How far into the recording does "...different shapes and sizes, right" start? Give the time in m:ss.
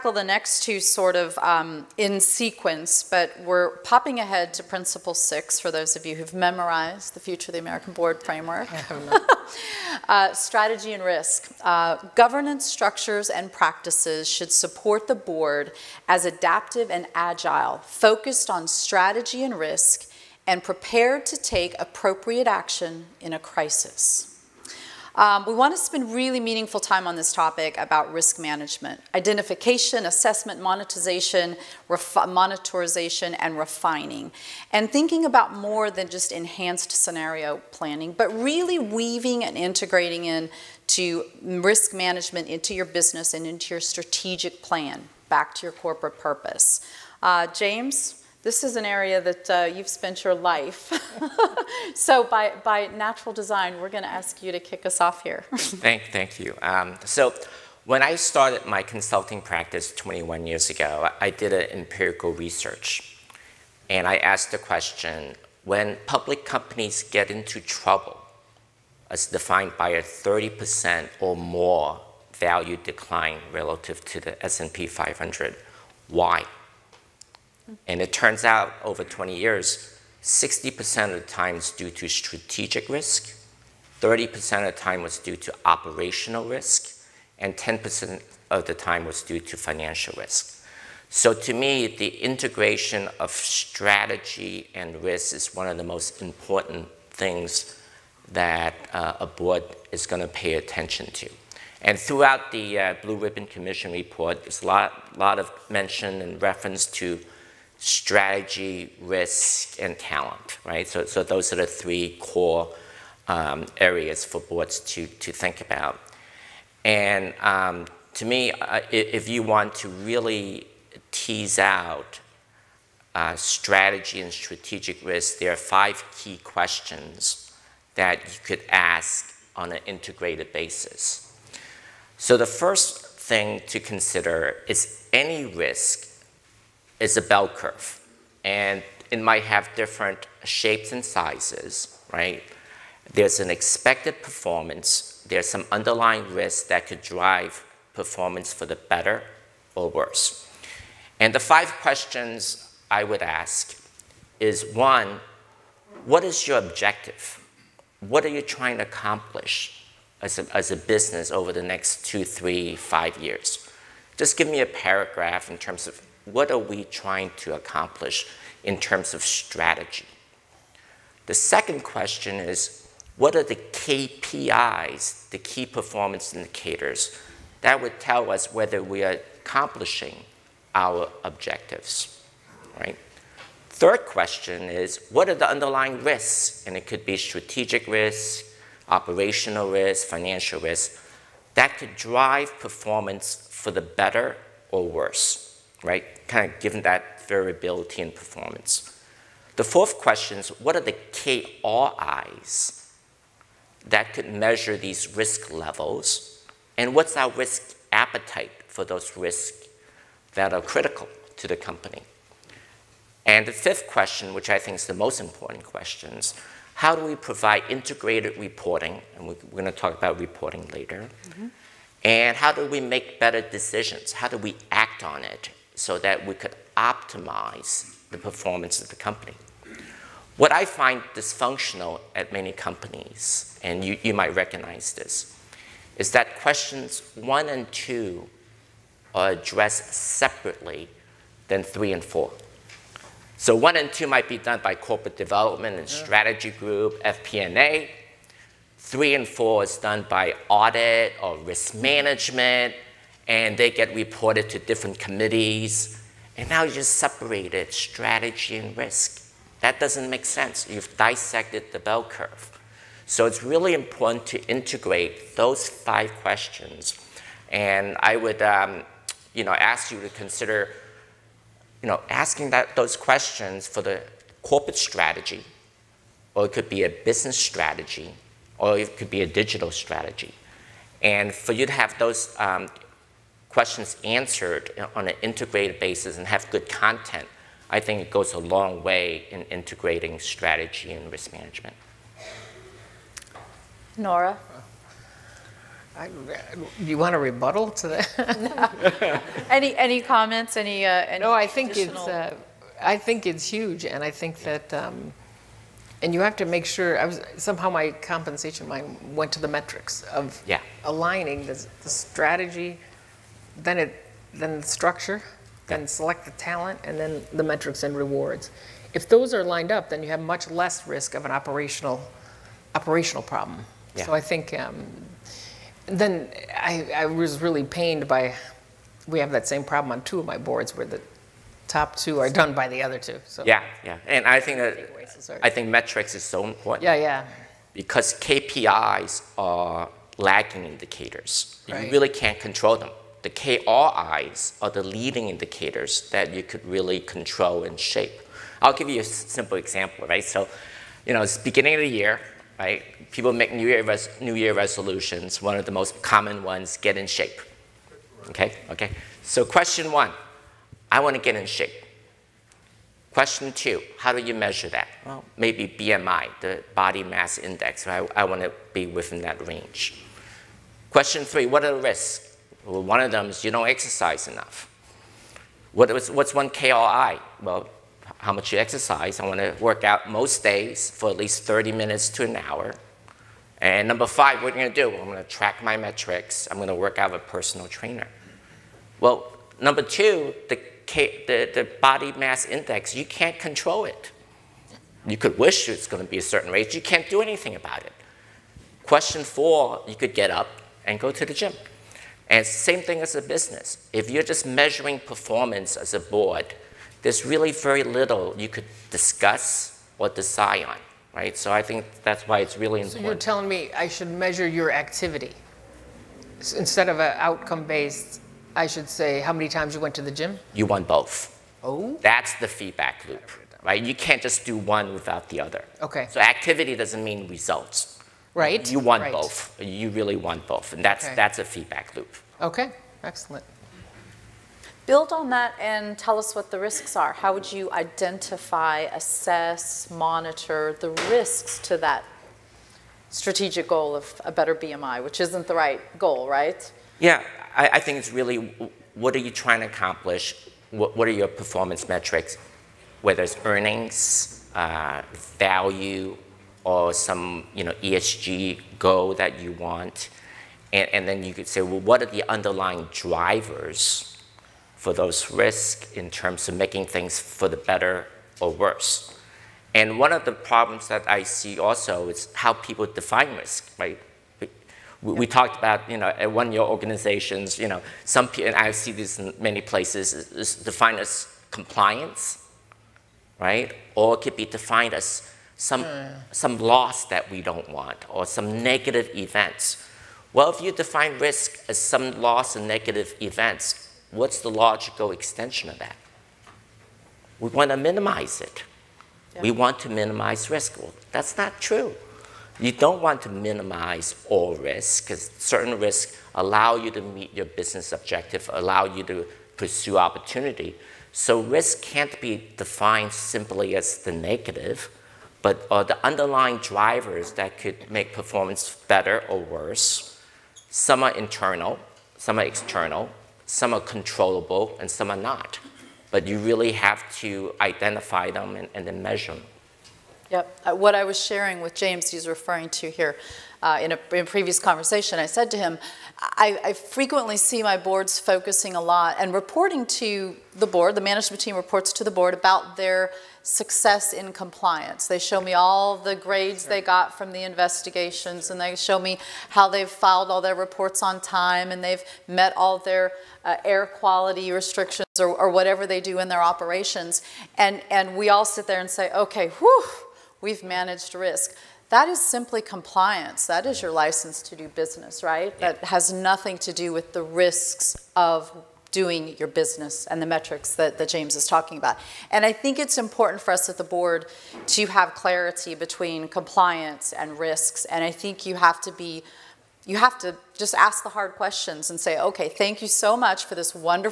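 2:19.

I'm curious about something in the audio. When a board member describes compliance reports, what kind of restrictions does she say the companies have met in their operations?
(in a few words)
air quality restrictions.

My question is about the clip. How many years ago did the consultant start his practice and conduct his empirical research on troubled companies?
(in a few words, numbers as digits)
21.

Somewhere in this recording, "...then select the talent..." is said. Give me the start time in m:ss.
5:15.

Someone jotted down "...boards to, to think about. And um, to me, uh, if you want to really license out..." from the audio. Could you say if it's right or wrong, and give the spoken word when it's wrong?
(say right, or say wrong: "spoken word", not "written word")
wrong: "tease", not "license".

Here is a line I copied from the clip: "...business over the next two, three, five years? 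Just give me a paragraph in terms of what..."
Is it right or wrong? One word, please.
right.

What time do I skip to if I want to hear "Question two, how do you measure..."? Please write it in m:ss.
6:03.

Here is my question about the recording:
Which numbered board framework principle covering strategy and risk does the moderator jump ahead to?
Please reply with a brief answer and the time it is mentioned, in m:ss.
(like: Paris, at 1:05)
Principle 6, at 0:04.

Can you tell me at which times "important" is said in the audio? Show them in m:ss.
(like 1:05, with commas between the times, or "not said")
1:36, 3:35, 4:23, 5:36, 6:52, 9:32.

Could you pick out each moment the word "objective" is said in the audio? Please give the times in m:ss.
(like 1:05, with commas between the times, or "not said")
2:36, 3:01, 8:27.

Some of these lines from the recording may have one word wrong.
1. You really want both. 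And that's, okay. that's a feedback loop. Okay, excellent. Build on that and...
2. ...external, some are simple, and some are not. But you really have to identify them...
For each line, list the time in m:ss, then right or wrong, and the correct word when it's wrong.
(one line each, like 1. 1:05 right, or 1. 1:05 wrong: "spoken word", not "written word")
1. 7:09 right
2. 8:42 wrong: "controllable", not "simple".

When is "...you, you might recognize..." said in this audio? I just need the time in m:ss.
3:53.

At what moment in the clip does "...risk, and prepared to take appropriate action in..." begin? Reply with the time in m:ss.
0:19.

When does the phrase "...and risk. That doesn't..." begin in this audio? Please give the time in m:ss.
4:18.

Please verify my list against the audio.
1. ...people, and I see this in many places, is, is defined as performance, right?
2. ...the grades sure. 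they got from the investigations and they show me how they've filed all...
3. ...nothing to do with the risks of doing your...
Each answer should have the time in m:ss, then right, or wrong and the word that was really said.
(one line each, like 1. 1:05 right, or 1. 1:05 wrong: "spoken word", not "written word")
1. 7:58 wrong: "compliance", not "performance"
2. 9:05 right
3. 9:26 right.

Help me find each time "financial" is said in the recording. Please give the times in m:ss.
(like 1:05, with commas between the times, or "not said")
1:29, 3:10.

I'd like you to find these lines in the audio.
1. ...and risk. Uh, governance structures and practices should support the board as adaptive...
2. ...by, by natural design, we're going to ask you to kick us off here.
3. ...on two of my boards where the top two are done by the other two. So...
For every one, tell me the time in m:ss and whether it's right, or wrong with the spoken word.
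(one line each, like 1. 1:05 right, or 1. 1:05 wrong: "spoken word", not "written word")
1. 0:10 right
2. 0:52 right
3. 5:29 right.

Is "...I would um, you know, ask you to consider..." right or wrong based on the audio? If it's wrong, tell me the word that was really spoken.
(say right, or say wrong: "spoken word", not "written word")
right.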